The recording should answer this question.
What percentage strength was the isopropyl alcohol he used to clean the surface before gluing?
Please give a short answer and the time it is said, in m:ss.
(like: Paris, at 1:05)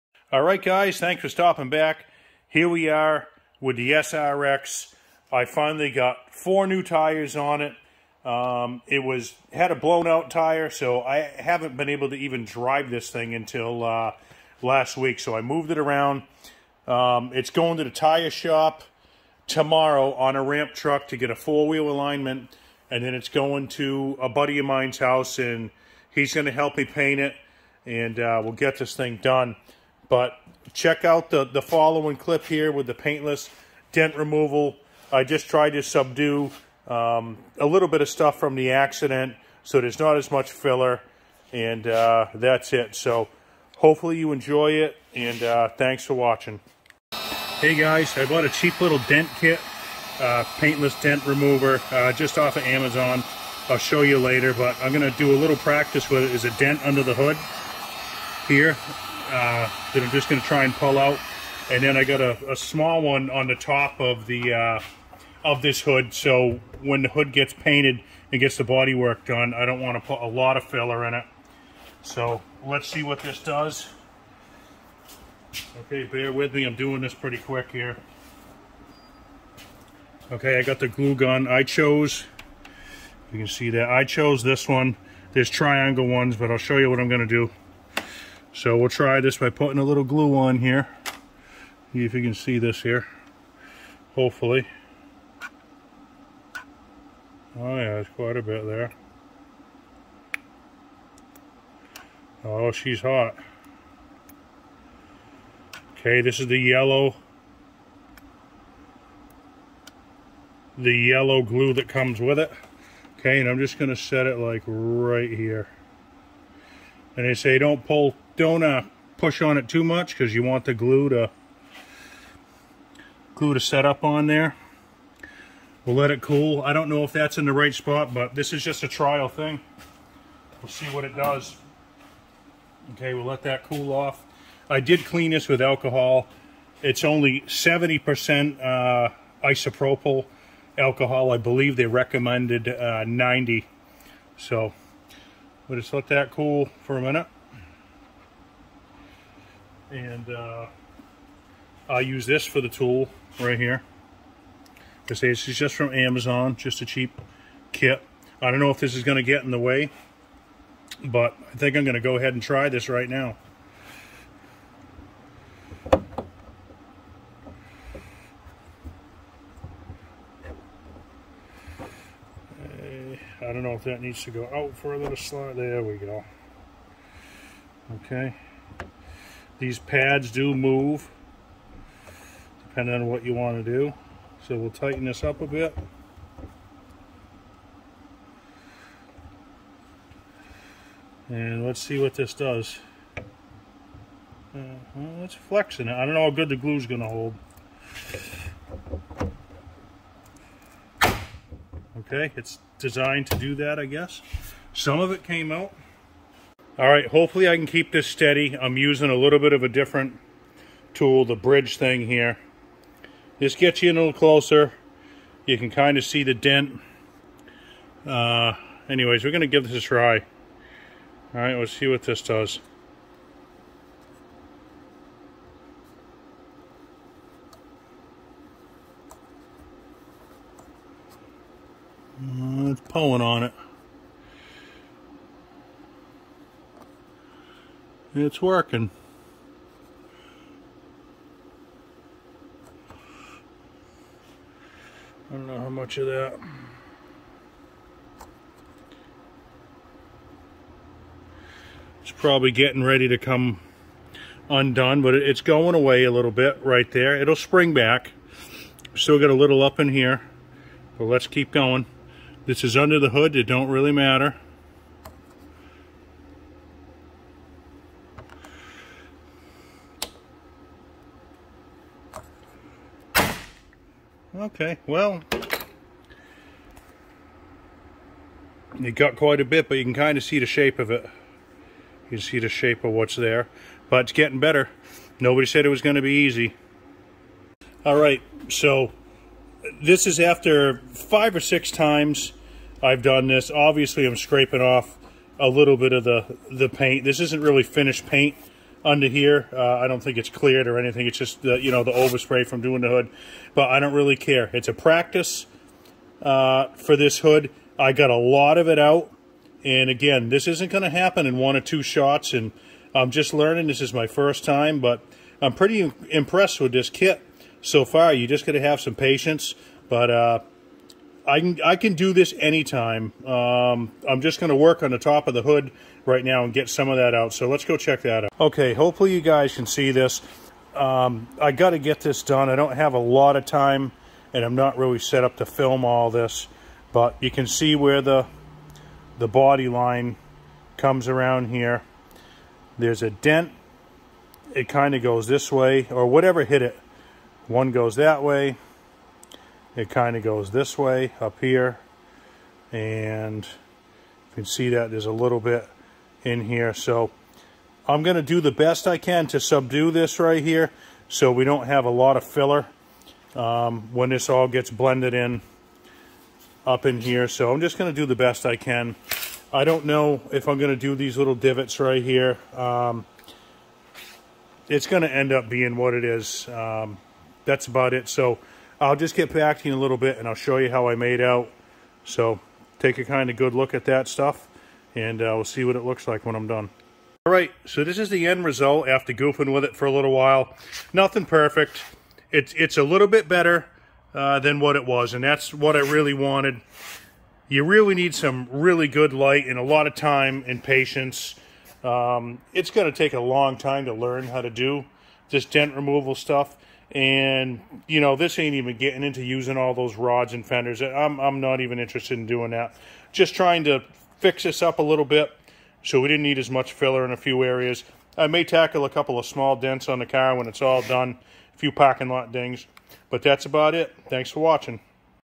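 70%, at 2:17.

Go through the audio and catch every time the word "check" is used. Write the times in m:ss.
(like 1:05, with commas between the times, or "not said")
0:30, 5:27.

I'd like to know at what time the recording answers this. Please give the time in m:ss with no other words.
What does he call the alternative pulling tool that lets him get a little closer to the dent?
3:31.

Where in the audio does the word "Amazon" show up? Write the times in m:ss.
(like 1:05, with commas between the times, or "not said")
0:52, 2:35.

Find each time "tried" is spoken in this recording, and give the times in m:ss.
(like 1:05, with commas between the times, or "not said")
0:35.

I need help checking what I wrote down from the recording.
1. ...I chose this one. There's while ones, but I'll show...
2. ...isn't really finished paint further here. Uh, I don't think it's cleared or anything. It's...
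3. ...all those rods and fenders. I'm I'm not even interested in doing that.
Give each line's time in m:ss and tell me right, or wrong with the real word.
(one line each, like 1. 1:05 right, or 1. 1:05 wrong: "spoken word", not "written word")
1. 1:23 wrong: "triangle", not "while"
2. 4:57 wrong: "under", not "further"
3. 6:49 right.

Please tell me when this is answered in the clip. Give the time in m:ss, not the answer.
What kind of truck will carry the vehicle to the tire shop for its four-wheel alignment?
0:20.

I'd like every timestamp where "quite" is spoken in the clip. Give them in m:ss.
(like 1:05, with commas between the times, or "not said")
1:38, 4:39.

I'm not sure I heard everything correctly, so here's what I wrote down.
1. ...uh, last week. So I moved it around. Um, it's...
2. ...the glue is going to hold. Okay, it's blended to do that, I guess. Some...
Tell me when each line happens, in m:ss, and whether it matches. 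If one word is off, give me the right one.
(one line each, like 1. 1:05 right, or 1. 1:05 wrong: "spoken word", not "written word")
1. 0:13 right
2. 3:16 wrong: "designed", not "blended".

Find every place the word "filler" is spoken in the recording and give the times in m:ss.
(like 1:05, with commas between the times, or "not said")
0:40, 1:10, 6:02, 6:56.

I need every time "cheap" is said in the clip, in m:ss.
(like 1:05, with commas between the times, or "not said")
0:48, 2:36.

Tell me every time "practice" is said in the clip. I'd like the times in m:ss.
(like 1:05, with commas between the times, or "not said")
0:55, 5:04.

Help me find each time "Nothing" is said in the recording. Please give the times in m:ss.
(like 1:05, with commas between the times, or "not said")
6:30.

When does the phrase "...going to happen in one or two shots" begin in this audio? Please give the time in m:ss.
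5:10.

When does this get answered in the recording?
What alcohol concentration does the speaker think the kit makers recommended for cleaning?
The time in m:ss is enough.
2:23.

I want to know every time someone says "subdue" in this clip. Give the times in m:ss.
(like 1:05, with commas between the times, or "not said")
0:35, 5:59.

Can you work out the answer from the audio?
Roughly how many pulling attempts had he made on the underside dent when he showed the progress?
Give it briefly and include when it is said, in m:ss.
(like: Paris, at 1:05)
Five or six, at 4:50.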